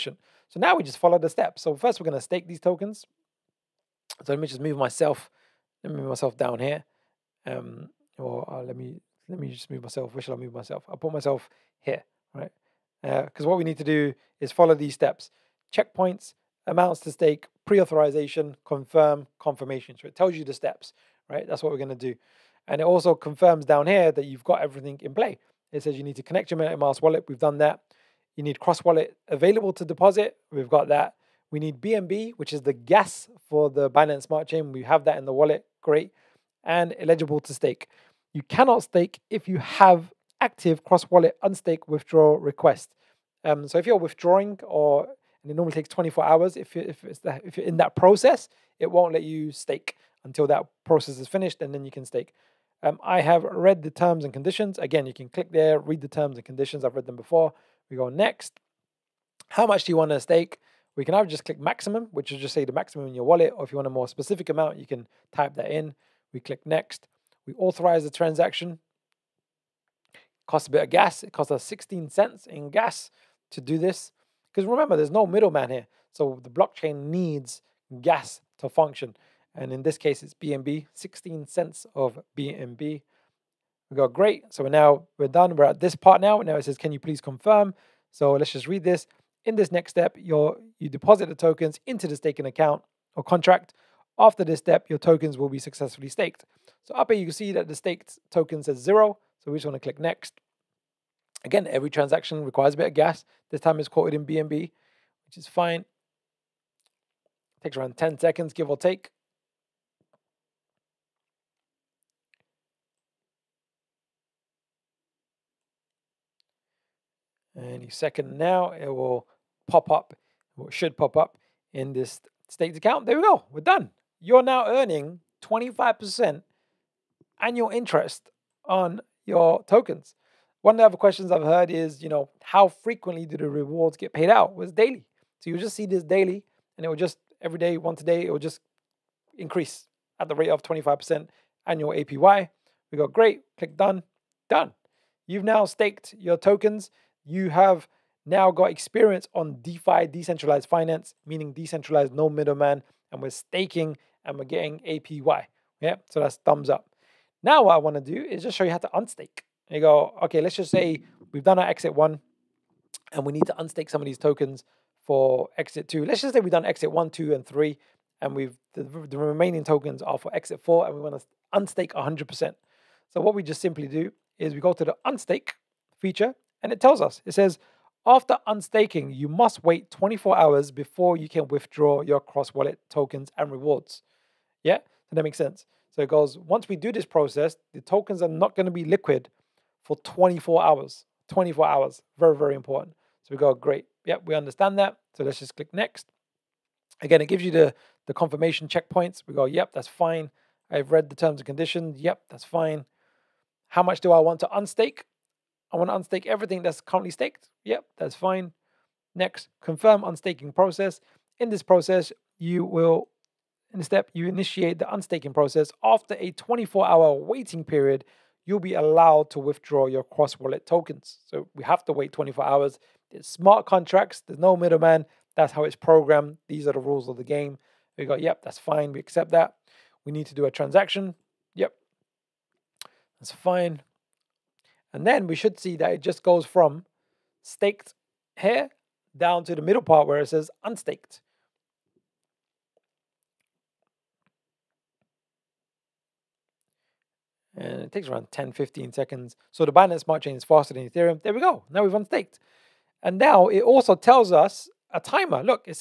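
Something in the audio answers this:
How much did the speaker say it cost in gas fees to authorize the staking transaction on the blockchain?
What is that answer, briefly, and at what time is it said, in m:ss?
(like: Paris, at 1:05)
16 cents, at 1:11.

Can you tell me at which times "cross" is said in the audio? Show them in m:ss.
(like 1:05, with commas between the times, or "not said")
0:28, 0:40, 3:02, 3:40.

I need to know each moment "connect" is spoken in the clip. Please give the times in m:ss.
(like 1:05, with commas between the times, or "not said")
0:26.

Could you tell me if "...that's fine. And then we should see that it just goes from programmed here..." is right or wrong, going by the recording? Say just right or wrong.
wrong.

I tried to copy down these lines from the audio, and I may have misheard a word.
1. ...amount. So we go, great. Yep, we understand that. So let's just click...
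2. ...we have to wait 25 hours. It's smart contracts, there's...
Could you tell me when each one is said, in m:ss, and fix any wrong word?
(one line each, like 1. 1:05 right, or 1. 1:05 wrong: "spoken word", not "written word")
1. 3:12 wrong: "important", not "amount"
2. 3:41 wrong: "24", not "25".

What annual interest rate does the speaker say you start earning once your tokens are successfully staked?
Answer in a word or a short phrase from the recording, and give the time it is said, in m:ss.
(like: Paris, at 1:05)
25%, at 2:05.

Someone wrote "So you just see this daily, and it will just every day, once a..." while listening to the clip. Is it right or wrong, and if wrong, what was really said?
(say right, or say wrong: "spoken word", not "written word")
right.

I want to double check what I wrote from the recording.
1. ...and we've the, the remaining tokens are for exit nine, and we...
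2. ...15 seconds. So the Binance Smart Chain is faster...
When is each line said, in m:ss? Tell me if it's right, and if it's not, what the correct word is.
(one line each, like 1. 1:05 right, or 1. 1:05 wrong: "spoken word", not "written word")
1. 2:48 wrong: "four", not "nine"
2. 4:08 right.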